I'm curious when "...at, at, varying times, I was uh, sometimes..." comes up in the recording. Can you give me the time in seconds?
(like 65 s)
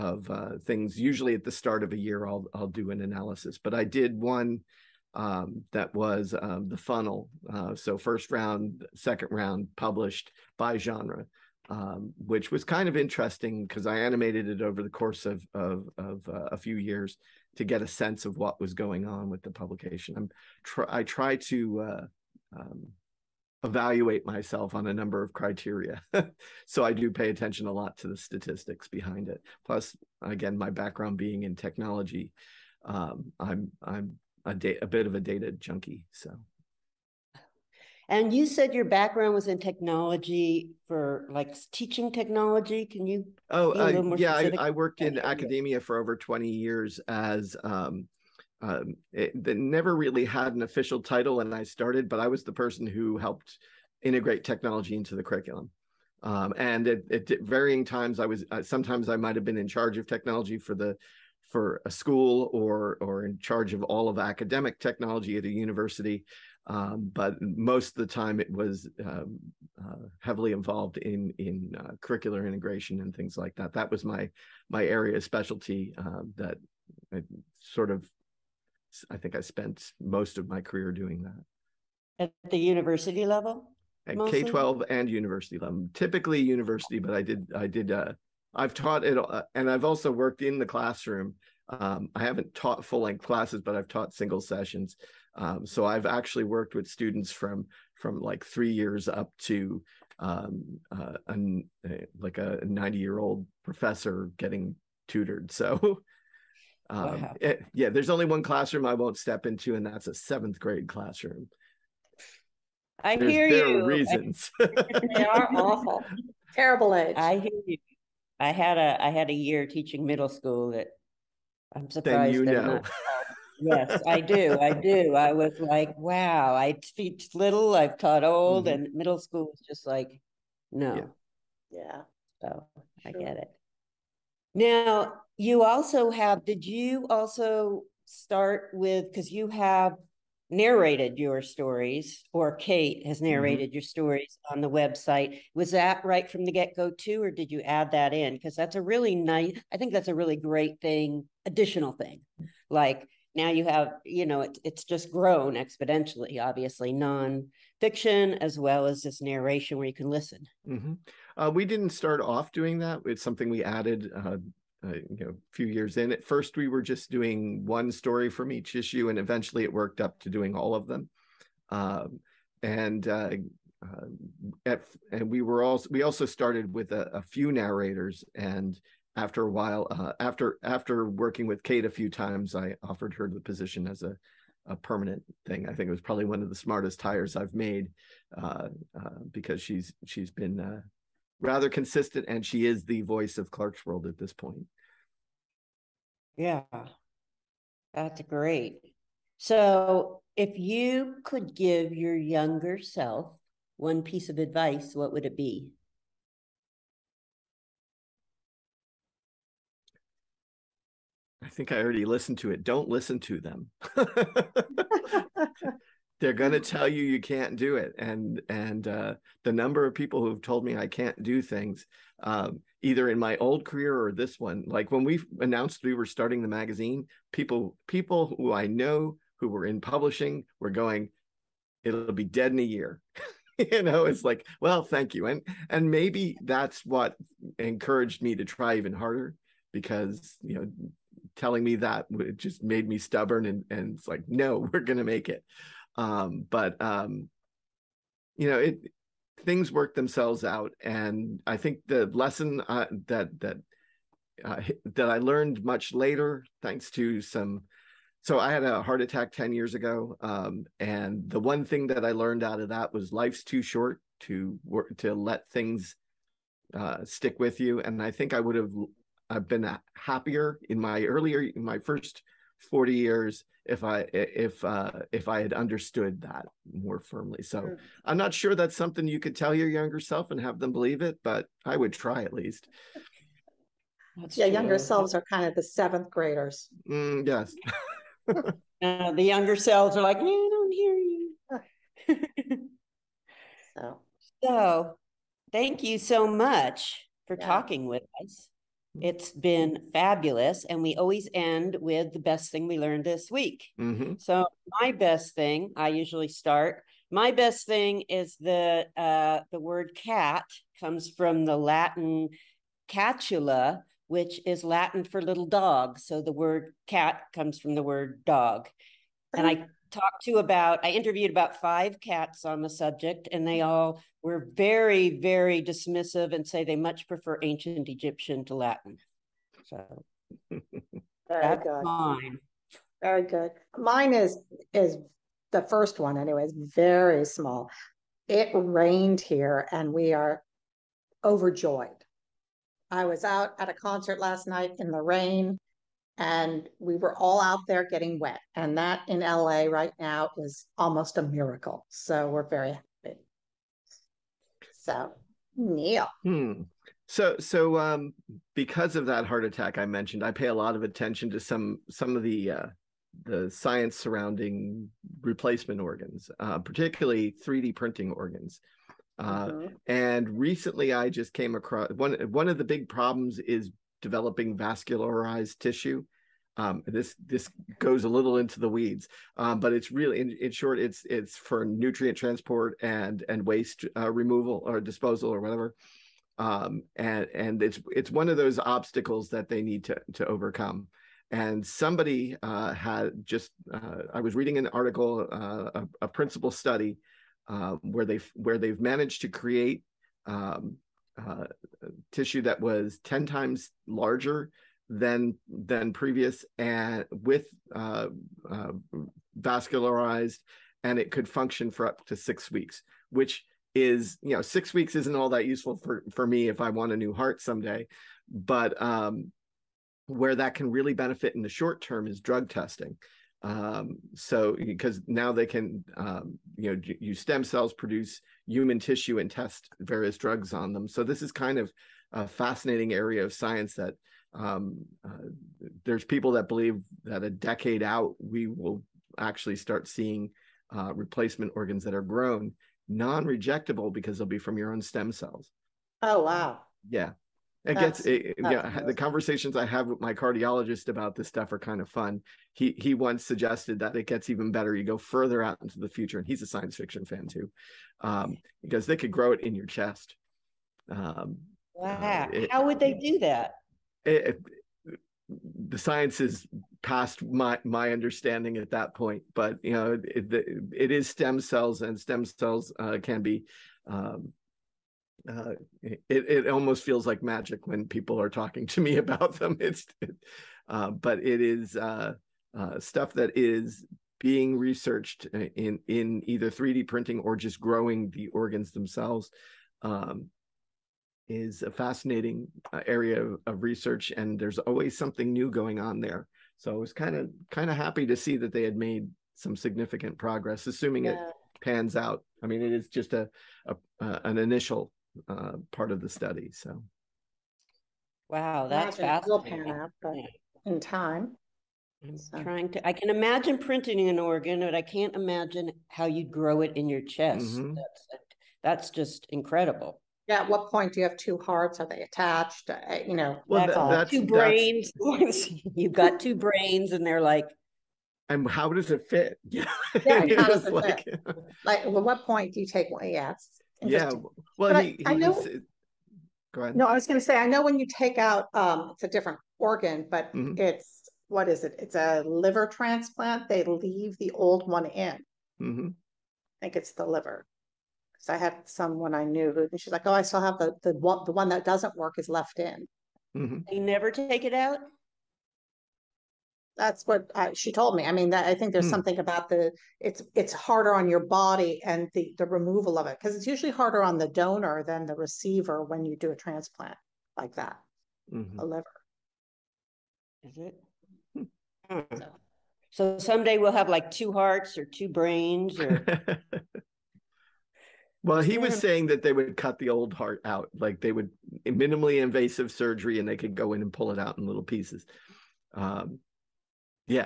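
56 s.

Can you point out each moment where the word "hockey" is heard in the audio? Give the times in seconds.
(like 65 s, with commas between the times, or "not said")
not said.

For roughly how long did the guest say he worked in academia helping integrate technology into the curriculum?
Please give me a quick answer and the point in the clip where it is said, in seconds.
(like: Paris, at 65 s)
over 20 years, at 45 s.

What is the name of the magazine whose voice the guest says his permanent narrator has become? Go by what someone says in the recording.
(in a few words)
Clarkesworld.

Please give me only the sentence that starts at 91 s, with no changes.
Um, I haven't taught full length classes, but I've taught single sessions.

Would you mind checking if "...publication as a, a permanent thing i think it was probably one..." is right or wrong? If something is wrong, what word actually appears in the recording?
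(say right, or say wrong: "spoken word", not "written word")
wrong: "position", not "publication".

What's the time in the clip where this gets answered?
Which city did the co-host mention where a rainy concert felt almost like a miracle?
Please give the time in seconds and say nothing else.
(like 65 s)
349 s.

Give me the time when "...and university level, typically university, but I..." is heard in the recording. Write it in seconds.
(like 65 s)
84 s.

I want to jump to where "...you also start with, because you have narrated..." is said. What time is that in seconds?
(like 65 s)
136 s.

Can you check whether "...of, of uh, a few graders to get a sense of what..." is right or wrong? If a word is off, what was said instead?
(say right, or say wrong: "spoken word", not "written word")
wrong: "years", not "graders".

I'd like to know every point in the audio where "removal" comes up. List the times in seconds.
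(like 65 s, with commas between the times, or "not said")
384 s, 562 s.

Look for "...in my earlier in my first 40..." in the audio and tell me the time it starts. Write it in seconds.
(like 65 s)
270 s.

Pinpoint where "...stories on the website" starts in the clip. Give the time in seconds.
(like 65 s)
143 s.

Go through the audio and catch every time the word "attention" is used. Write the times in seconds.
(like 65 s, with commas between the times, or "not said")
27 s, 360 s.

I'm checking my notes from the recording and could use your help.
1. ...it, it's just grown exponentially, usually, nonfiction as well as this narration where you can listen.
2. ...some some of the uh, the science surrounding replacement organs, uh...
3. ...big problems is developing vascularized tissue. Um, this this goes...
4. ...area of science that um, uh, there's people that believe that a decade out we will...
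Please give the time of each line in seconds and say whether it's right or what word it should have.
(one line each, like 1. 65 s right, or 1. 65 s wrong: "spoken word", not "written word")
1. 154 s wrong: "obviously", not "usually"
2. 361 s right
3. 372 s right
4. 432 s right.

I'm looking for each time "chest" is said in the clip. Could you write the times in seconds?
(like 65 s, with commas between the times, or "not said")
459 s, 517 s.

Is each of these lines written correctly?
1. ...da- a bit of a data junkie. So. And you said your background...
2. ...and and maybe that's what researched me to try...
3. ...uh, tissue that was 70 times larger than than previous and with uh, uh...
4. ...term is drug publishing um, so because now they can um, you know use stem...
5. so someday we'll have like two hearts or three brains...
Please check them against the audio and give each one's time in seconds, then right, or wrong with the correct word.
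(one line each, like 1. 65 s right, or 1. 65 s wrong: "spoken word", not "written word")
1. 34 s right
2. 235 s wrong: "encouraged", not "researched"
3. 401 s wrong: "10", not "70"
4. 421 s wrong: "testing", not "publishing"
5. 572 s wrong: "two", not "three".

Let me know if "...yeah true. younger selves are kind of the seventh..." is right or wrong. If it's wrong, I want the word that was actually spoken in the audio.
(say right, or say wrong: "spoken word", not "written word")
right.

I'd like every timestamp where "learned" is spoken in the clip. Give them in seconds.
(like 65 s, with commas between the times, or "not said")
255 s, 262 s, 302 s.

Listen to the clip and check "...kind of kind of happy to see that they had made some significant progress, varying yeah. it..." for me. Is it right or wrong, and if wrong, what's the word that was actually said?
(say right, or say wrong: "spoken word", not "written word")
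wrong: "assuming", not "varying".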